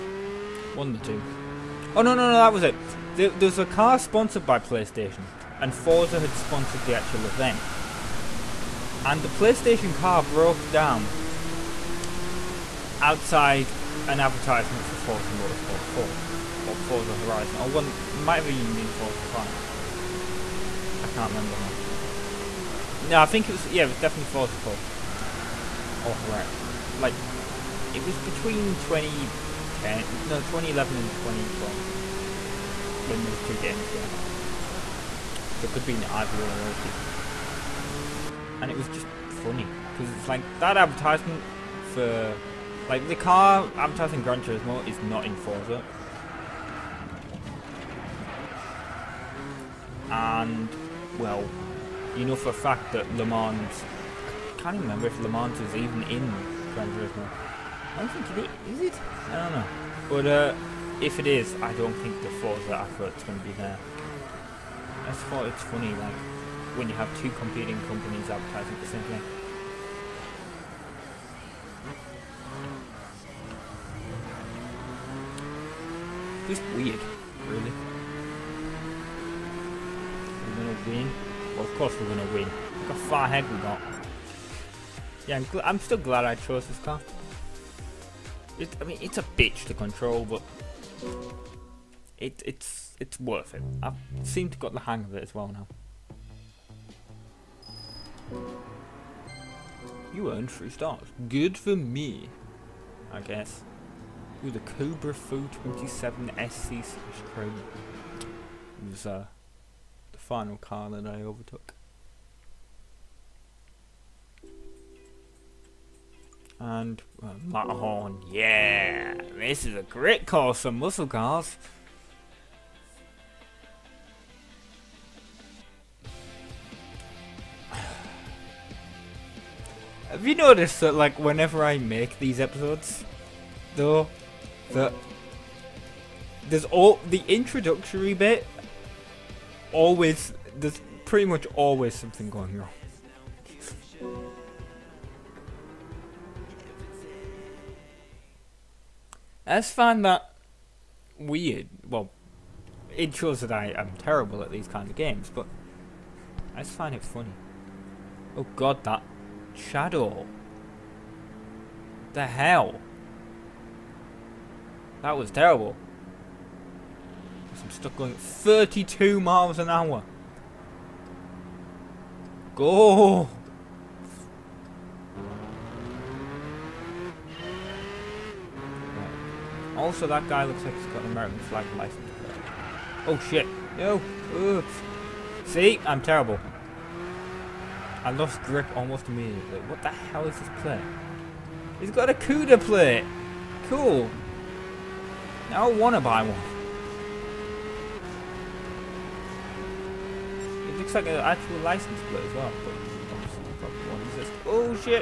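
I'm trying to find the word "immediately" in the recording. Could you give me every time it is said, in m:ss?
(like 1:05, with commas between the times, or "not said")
3:09.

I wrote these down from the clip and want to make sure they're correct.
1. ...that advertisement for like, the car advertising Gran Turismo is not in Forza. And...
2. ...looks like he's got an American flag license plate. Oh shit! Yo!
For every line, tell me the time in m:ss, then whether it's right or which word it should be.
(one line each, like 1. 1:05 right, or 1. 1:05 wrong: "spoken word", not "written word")
1. 0:40 right
2. 3:00 right.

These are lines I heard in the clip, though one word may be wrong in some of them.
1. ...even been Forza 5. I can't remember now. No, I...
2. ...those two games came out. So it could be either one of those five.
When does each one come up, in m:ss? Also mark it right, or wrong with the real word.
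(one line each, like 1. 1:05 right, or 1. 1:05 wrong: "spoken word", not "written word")
1. 0:18 right
2. 0:33 wrong: "two", not "five".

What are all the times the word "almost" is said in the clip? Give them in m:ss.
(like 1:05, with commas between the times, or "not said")
3:08.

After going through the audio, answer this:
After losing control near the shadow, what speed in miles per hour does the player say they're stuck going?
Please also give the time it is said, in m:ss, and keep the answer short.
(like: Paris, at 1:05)
32, at 2:48.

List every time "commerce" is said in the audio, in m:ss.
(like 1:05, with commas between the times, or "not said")
not said.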